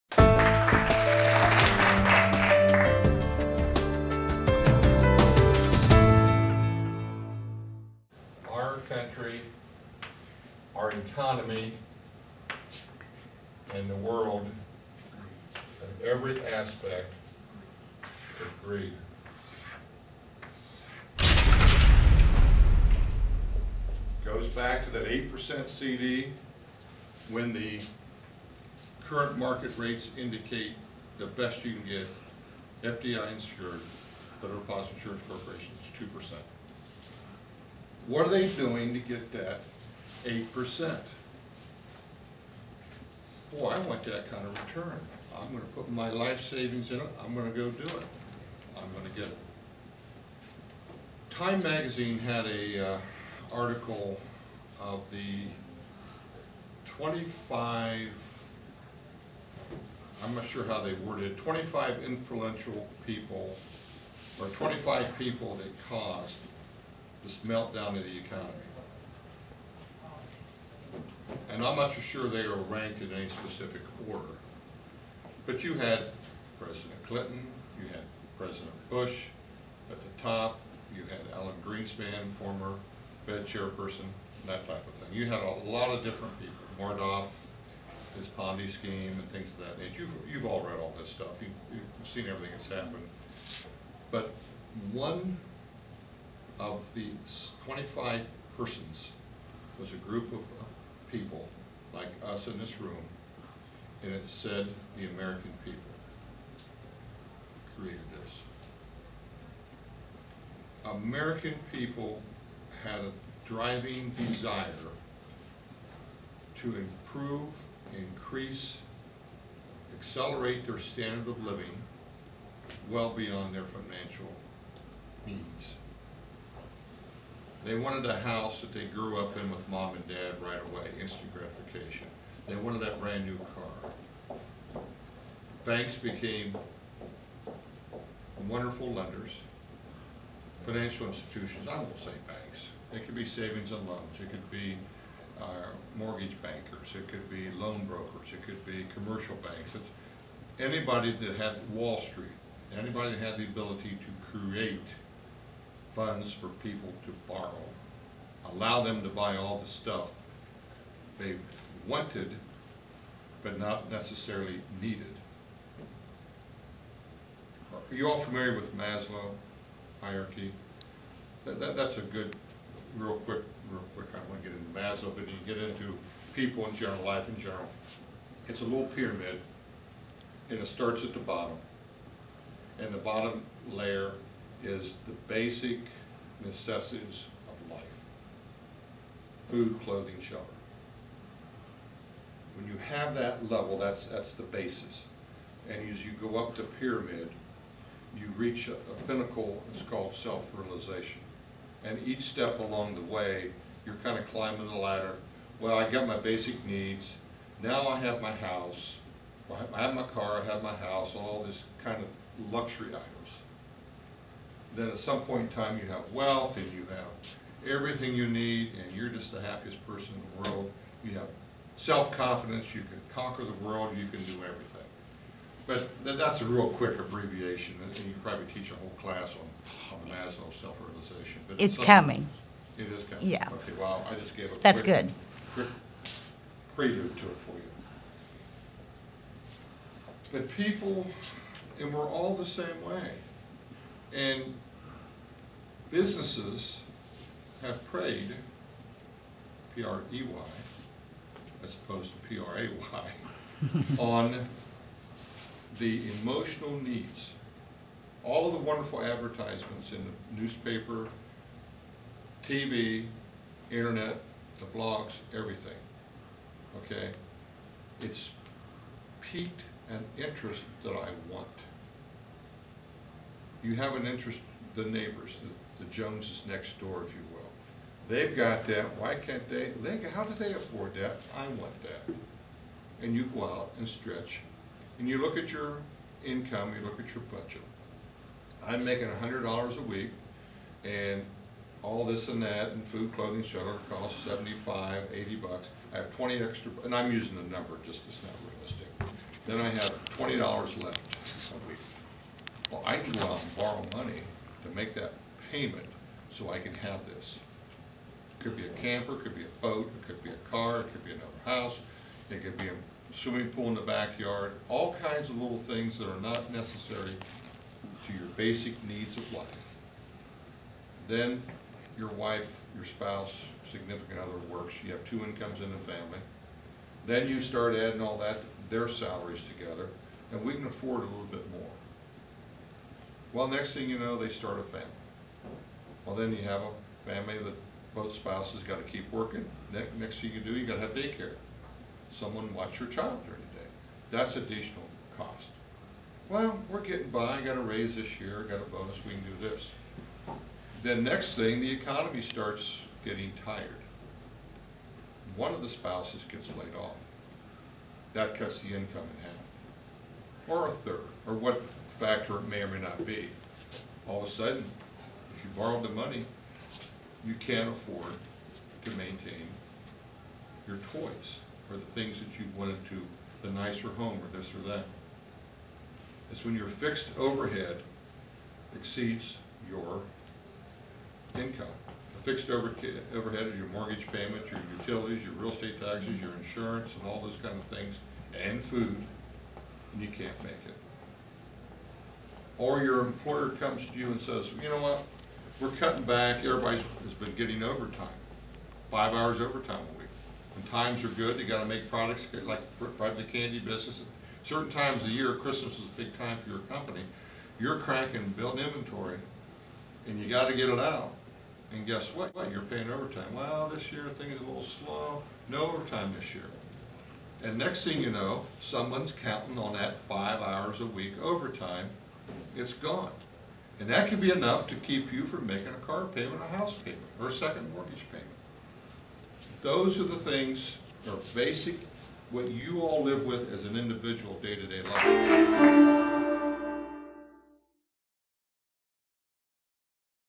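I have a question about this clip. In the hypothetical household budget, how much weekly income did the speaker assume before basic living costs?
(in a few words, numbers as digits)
100 dollars.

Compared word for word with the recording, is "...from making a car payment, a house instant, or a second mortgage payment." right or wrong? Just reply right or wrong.
wrong.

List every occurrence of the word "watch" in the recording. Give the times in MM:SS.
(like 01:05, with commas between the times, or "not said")
05:42.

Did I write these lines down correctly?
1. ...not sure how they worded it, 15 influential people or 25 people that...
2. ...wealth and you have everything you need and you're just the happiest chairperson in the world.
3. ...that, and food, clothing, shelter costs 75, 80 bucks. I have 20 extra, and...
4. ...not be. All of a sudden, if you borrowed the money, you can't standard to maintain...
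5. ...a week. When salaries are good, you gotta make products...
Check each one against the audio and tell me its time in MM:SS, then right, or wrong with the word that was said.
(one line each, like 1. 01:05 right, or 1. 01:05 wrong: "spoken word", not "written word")
1. 01:00 wrong: "25", not "15"
2. 03:36 wrong: "person", not "chairperson"
3. 04:52 right
4. 06:02 wrong: "afford", not "standard"
5. 06:39 wrong: "times", not "salaries".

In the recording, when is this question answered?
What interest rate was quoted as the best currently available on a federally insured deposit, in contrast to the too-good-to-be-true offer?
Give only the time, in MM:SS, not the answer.
00:36.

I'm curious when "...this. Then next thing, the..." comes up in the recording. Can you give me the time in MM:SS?
05:49.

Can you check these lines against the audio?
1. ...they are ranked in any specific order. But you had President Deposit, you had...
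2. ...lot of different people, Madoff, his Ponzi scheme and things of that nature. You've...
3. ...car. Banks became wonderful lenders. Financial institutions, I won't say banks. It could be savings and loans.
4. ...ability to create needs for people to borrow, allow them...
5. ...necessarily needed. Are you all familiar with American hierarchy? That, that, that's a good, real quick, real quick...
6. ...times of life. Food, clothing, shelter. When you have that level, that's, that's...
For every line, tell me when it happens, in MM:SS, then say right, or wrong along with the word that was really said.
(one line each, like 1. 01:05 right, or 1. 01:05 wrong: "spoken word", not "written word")
1. 01:12 wrong: "Clinton", not "Deposit"
2. 01:25 right
3. 02:13 right
4. 02:33 wrong: "funds", not "needs"
5. 02:43 wrong: "Maslow", not "American"
6. 03:06 wrong: "necessities", not "times".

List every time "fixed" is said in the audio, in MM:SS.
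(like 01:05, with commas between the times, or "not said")
06:16, 06:22.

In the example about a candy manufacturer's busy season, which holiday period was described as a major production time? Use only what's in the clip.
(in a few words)
Christmas.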